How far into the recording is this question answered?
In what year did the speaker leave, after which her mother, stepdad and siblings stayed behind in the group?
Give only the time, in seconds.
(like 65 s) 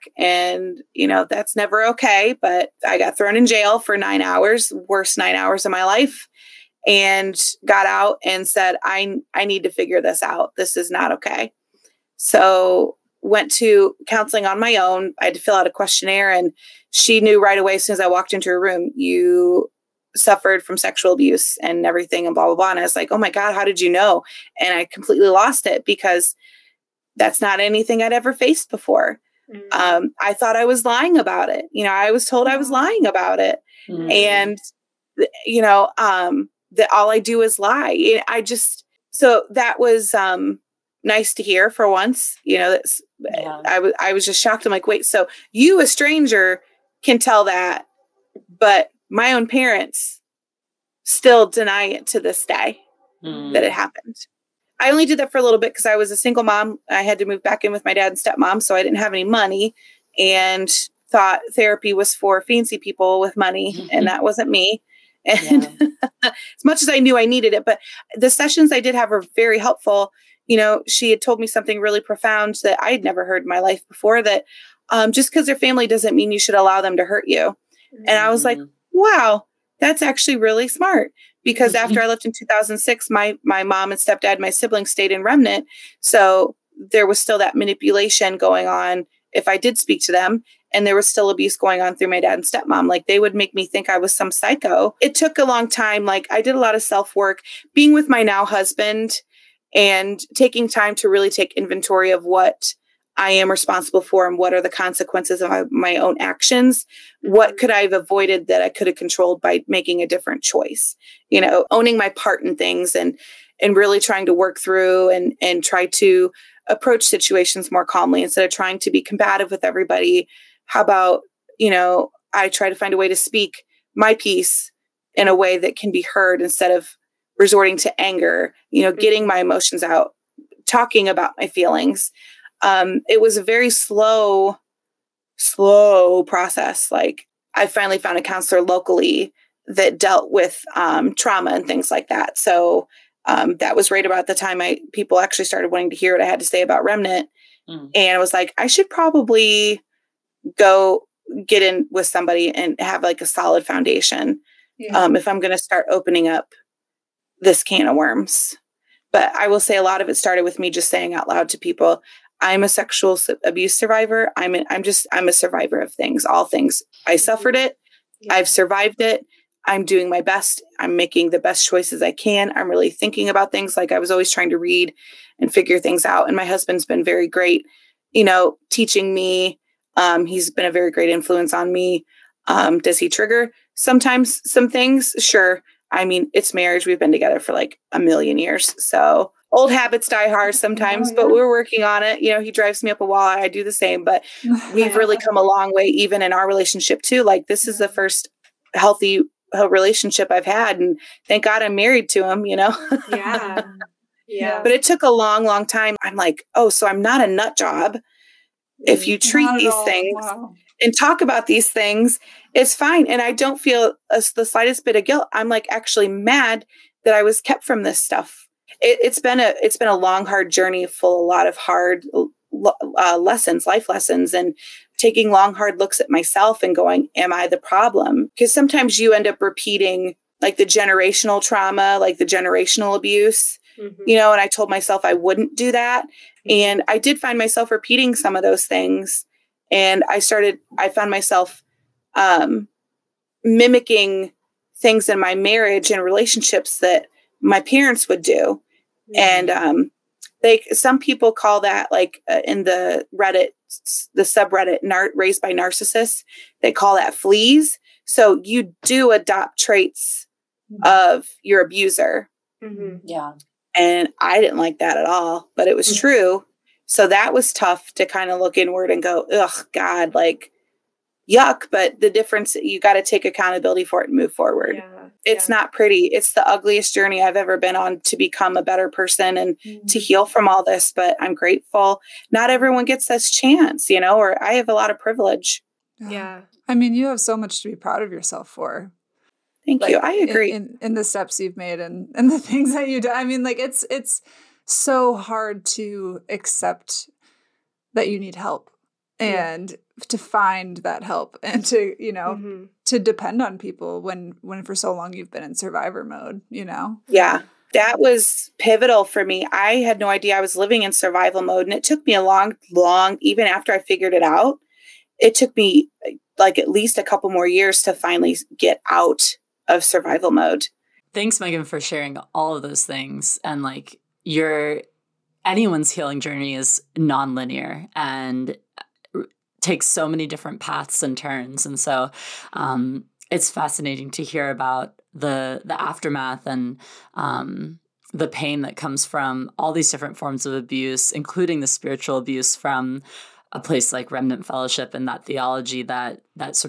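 82 s.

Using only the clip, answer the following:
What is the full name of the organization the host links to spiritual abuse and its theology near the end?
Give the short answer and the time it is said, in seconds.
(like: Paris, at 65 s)
Remnant Fellowship, at 344 s.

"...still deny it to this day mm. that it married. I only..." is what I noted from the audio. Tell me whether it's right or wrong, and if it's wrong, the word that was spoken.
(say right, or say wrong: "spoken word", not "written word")
wrong: "happened", not "married".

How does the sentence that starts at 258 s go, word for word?
So you do adopt traits mm-hmm.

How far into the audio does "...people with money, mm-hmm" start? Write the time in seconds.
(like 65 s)
62 s.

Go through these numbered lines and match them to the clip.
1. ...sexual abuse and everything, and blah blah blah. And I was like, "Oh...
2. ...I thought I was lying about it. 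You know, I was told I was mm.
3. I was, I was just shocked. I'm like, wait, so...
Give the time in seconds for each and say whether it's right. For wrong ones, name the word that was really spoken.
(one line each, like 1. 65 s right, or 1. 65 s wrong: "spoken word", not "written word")
1. 20 s right
2. 30 s right
3. 43 s right.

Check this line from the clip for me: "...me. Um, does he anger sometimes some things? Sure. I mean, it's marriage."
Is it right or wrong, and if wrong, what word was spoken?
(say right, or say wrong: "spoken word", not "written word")
wrong: "trigger", not "anger".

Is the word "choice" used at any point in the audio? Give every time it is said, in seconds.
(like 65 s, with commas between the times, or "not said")
110 s, 171 s.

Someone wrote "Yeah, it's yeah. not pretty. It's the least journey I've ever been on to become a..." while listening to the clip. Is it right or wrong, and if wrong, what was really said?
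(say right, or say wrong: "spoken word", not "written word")
wrong: "ugliest", not "least".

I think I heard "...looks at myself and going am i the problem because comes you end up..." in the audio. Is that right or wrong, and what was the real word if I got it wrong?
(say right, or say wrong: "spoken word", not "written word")
wrong: "sometimes", not "comes".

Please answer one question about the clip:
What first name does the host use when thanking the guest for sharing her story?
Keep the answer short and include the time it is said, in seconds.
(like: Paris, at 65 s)
Megan, at 321 s.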